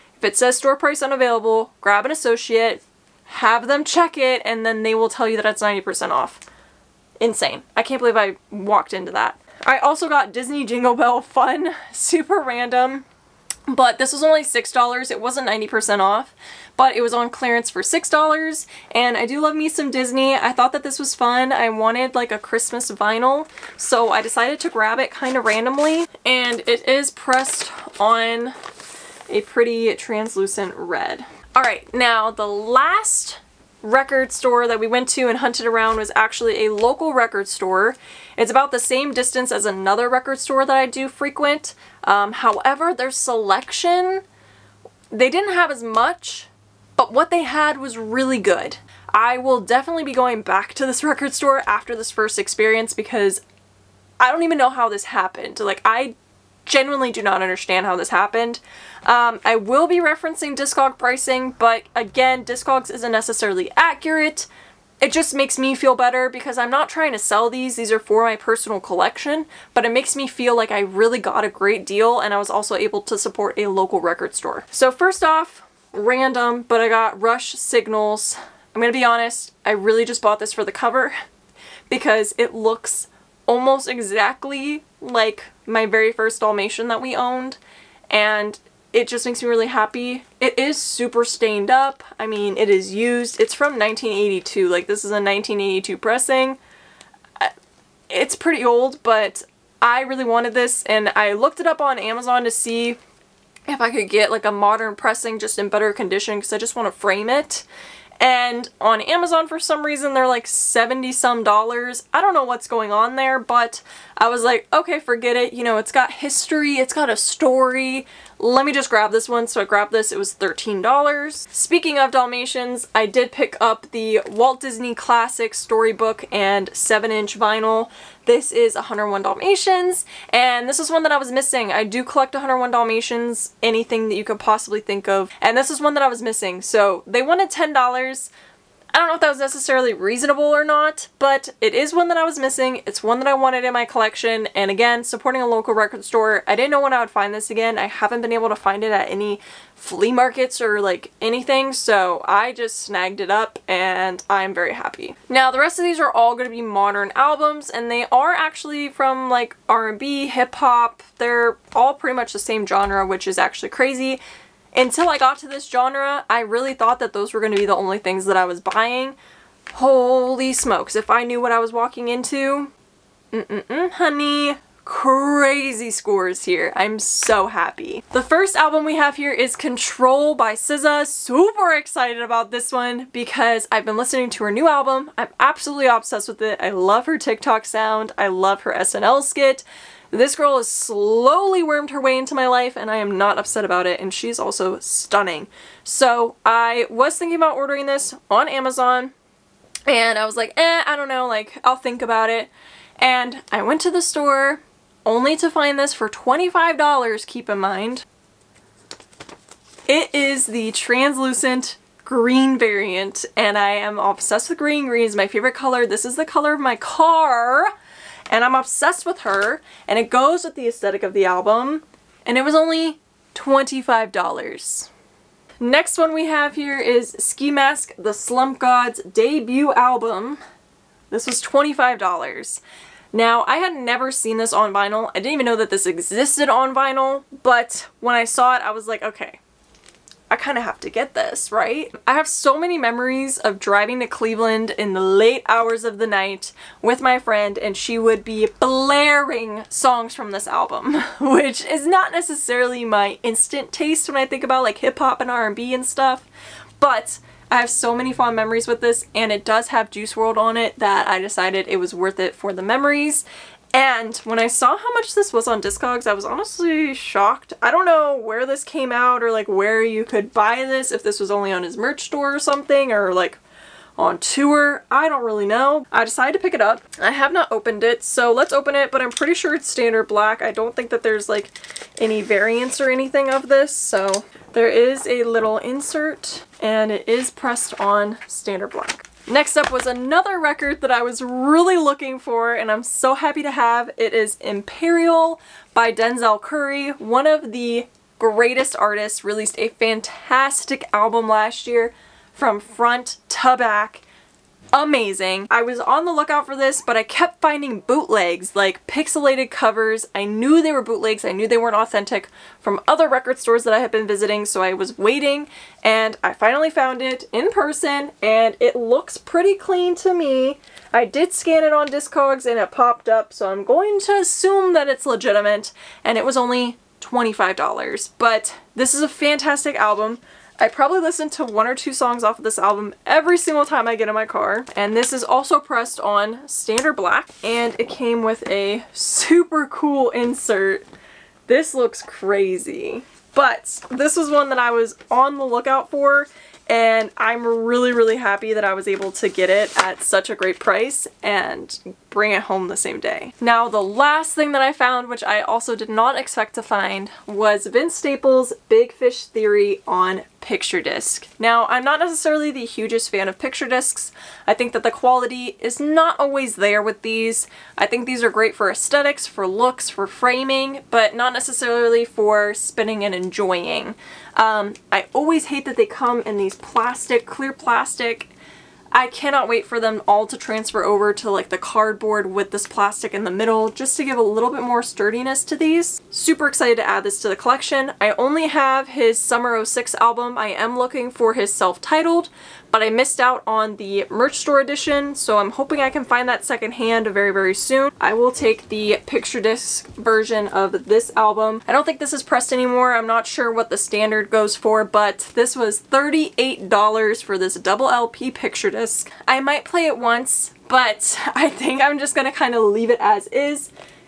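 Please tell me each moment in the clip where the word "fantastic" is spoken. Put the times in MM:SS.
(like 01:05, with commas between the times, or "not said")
04:59, 05:29.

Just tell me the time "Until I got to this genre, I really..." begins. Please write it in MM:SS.
02:44.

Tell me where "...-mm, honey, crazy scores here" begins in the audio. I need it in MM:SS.
02:53.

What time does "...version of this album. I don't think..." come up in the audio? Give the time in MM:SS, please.
06:39.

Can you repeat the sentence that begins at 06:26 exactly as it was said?
Super excited to add this to the collection.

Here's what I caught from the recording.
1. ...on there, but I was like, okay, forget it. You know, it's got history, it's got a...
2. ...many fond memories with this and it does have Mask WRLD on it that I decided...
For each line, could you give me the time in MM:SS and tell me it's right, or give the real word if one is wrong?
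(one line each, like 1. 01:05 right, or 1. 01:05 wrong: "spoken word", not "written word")
1. 01:52 right
2. 04:17 wrong: "Juice", not "Mask".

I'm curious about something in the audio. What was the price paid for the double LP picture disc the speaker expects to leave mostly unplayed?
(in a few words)
$38.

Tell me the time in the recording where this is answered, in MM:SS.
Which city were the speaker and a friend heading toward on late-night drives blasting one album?
04:04.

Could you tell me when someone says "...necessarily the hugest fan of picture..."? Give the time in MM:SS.
06:01.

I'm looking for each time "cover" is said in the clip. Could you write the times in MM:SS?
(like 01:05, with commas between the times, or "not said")
01:20, 05:09.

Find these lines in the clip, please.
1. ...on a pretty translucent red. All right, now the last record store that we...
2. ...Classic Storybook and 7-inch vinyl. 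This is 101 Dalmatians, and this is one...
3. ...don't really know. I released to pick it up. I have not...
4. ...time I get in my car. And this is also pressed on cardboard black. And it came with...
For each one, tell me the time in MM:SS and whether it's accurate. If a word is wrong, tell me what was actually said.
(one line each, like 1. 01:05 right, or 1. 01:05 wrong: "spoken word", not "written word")
1. 00:27 right
2. 02:04 right
3. 04:35 wrong: "decided", not "released"
4. 05:33 wrong: "standard", not "cardboard".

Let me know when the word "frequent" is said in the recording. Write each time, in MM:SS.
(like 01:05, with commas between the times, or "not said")
00:41.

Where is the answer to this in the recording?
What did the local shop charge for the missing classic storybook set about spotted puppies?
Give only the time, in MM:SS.
02:17.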